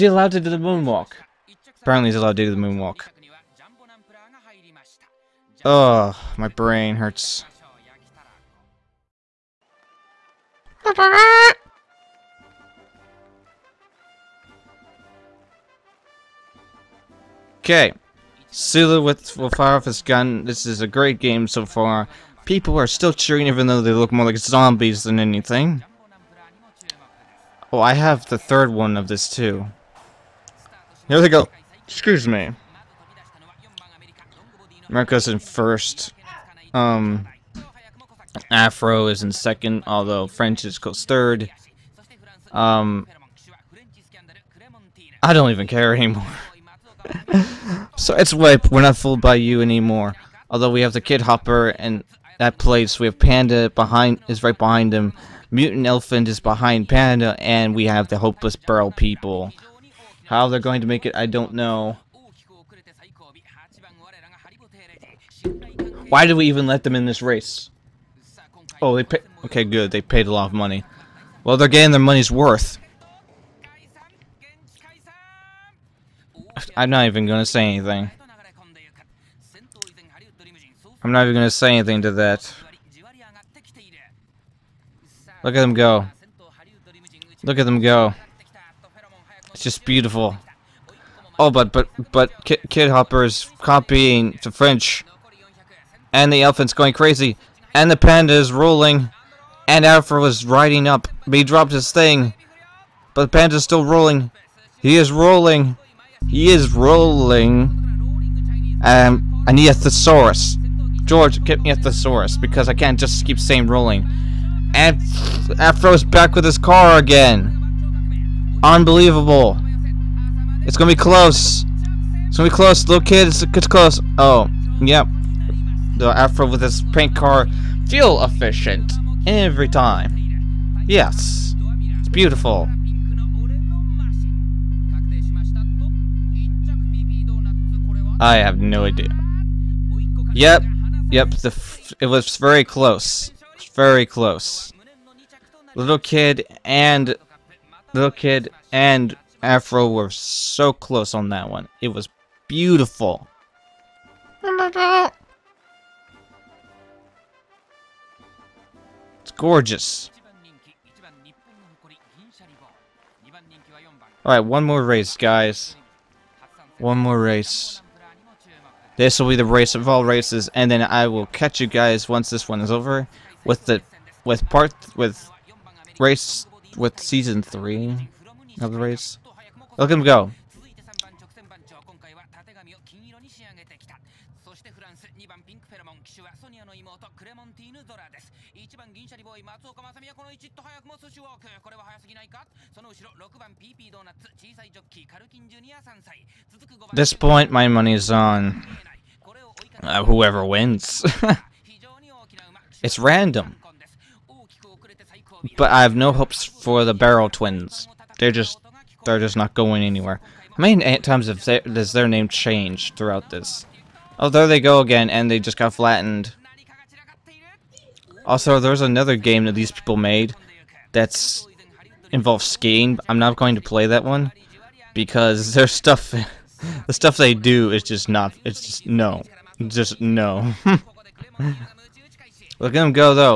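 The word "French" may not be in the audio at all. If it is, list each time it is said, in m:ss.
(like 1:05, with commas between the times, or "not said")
0:40, 1:34.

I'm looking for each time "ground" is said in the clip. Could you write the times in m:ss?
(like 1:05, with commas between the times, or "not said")
not said.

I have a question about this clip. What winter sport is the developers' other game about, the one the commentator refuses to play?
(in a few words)
skiing.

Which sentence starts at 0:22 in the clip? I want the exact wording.
People are still cheering even though they look more like zombies than anything.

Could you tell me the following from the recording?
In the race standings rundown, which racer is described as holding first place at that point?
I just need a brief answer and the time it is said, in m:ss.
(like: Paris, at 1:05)
America, at 0:34.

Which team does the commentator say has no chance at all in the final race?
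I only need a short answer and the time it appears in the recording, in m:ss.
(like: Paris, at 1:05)
barrel twins, at 3:26.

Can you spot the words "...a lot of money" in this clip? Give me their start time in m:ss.
1:10.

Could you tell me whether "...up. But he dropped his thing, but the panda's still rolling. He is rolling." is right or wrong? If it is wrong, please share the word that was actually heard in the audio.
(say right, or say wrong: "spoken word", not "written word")
right.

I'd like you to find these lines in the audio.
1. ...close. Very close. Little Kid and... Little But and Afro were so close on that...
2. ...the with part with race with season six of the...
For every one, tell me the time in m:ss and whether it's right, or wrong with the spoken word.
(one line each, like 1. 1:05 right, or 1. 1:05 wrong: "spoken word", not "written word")
1. 2:22 wrong: "Kid", not "But"
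2. 2:53 wrong: "three", not "six".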